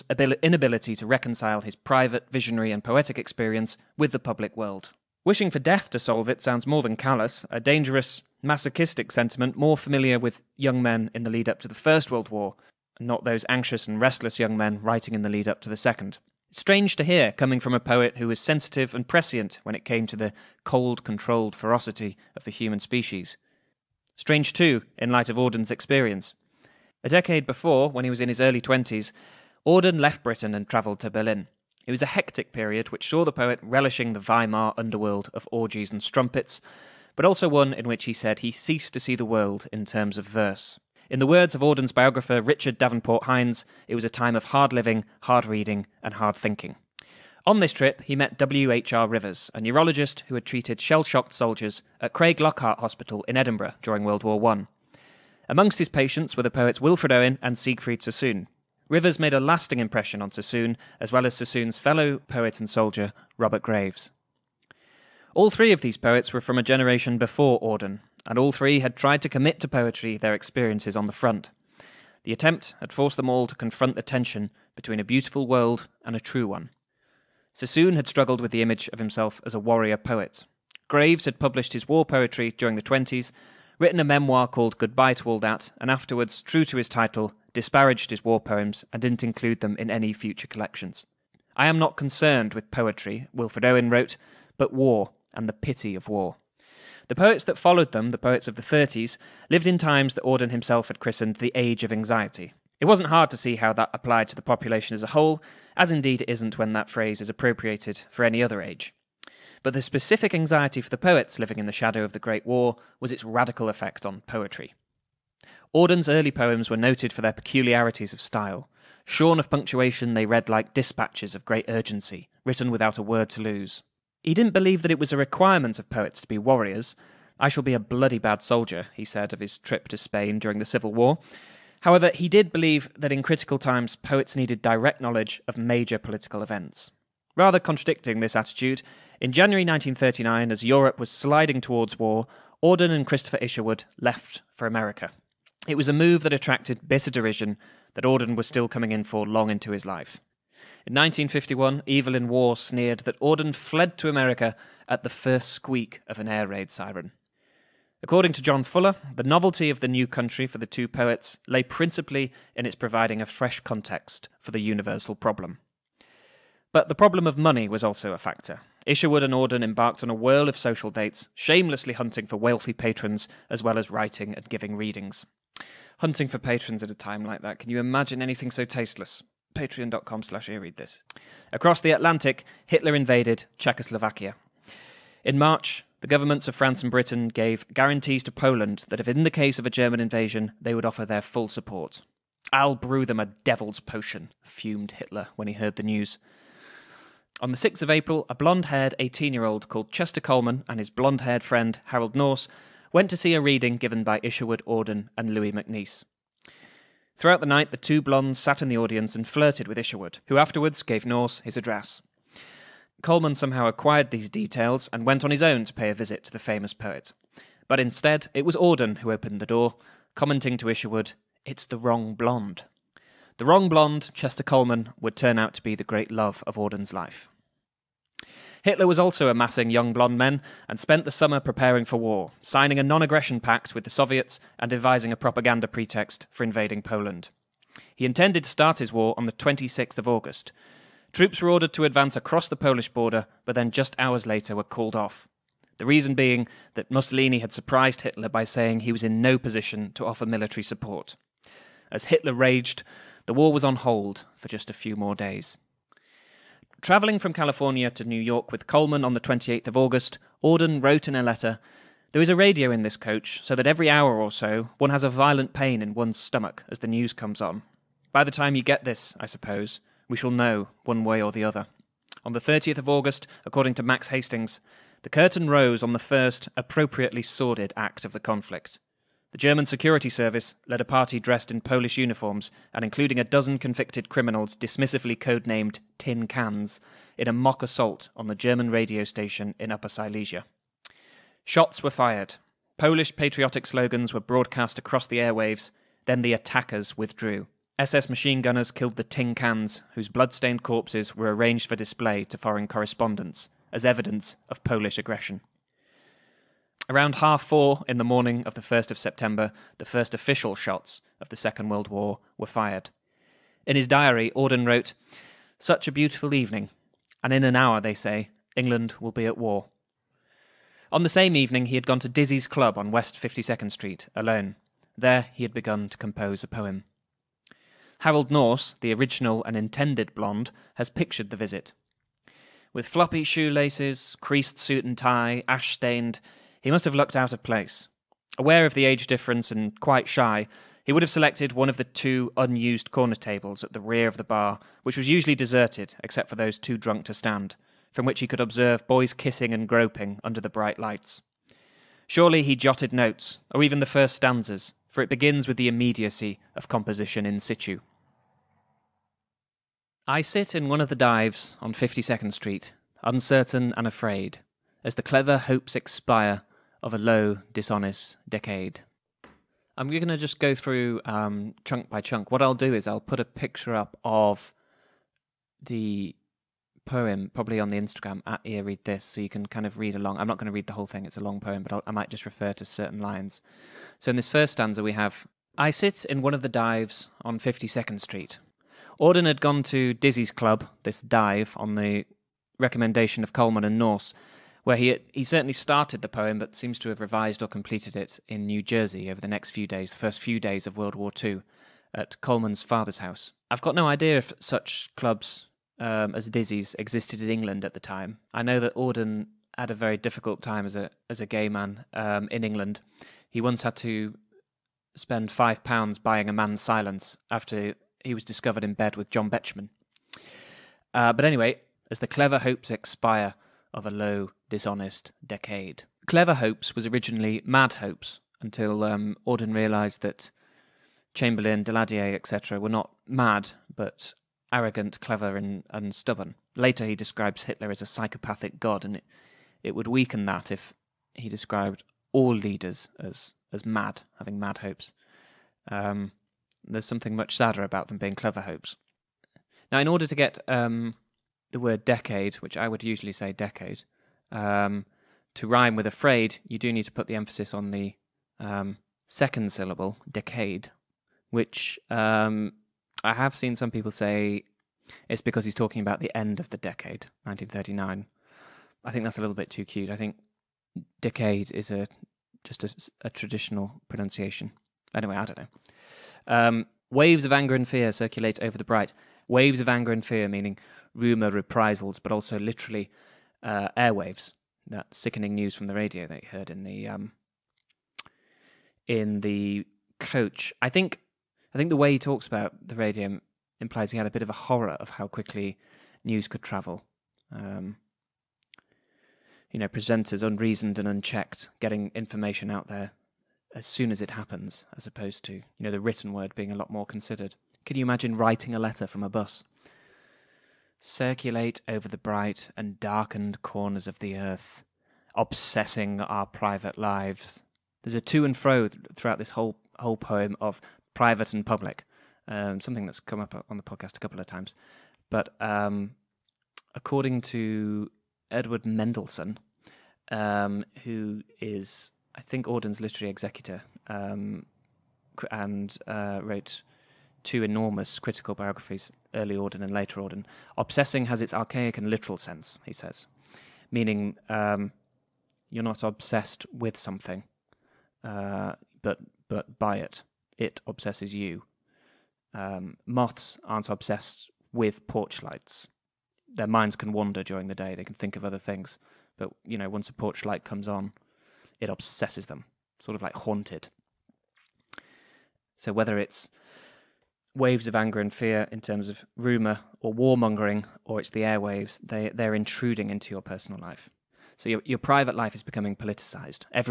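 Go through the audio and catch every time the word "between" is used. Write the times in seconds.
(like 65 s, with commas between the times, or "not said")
74 s.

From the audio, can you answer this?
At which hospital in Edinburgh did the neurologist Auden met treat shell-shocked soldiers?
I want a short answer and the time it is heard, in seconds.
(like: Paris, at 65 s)
Craig Lockhart Hospital, at 52 s.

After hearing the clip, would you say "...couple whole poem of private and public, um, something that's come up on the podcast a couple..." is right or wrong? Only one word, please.
wrong.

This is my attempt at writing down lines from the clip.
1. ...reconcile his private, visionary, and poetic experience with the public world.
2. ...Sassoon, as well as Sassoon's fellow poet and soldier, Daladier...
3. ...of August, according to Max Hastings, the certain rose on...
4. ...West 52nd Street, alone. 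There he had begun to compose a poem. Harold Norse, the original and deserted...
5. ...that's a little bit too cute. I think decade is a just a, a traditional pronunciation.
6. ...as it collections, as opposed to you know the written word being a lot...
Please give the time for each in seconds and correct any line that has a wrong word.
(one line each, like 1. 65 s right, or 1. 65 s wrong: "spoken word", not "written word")
1. 1 s right
2. 60 s wrong: "Robert", not "Daladier"
3. 272 s wrong: "curtain", not "certain"
4. 322 s wrong: "intended", not "deserted"
5. 469 s right
6. 503 s wrong: "happens", not "collections".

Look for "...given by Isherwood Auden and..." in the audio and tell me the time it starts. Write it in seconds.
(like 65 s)
203 s.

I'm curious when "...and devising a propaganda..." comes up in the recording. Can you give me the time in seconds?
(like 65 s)
234 s.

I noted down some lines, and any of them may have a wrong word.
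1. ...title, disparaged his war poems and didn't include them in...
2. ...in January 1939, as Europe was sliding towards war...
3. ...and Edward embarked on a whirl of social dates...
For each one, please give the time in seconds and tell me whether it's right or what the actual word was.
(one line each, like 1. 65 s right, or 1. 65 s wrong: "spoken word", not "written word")
1. 86 s right
2. 139 s right
3. 169 s wrong: "Auden", not "Edward".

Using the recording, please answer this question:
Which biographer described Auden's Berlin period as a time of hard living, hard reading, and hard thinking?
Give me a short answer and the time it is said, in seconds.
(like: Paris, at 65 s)
Richard Davenport Hines, at 42 s.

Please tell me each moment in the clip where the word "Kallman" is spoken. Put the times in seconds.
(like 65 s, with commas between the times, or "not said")
200 s, 213 s, 224 s, 258 s, 393 s, 402 s.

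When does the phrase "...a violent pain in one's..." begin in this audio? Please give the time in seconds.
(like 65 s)
265 s.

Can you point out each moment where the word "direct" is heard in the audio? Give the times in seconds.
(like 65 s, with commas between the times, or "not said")
134 s.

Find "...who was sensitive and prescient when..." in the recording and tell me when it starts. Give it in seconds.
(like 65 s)
18 s.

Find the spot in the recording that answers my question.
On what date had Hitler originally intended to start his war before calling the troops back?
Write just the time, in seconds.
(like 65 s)
239 s.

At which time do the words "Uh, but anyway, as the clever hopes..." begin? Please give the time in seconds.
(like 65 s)
420 s.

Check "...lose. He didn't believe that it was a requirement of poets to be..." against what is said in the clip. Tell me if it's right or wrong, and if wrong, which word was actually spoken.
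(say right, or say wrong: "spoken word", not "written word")
right.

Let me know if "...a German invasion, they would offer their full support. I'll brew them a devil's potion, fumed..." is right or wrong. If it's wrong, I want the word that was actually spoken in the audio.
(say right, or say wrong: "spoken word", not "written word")
right.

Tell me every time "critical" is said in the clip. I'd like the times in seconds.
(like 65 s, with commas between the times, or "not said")
133 s, 537 s.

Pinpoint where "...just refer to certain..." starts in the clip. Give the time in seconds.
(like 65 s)
382 s.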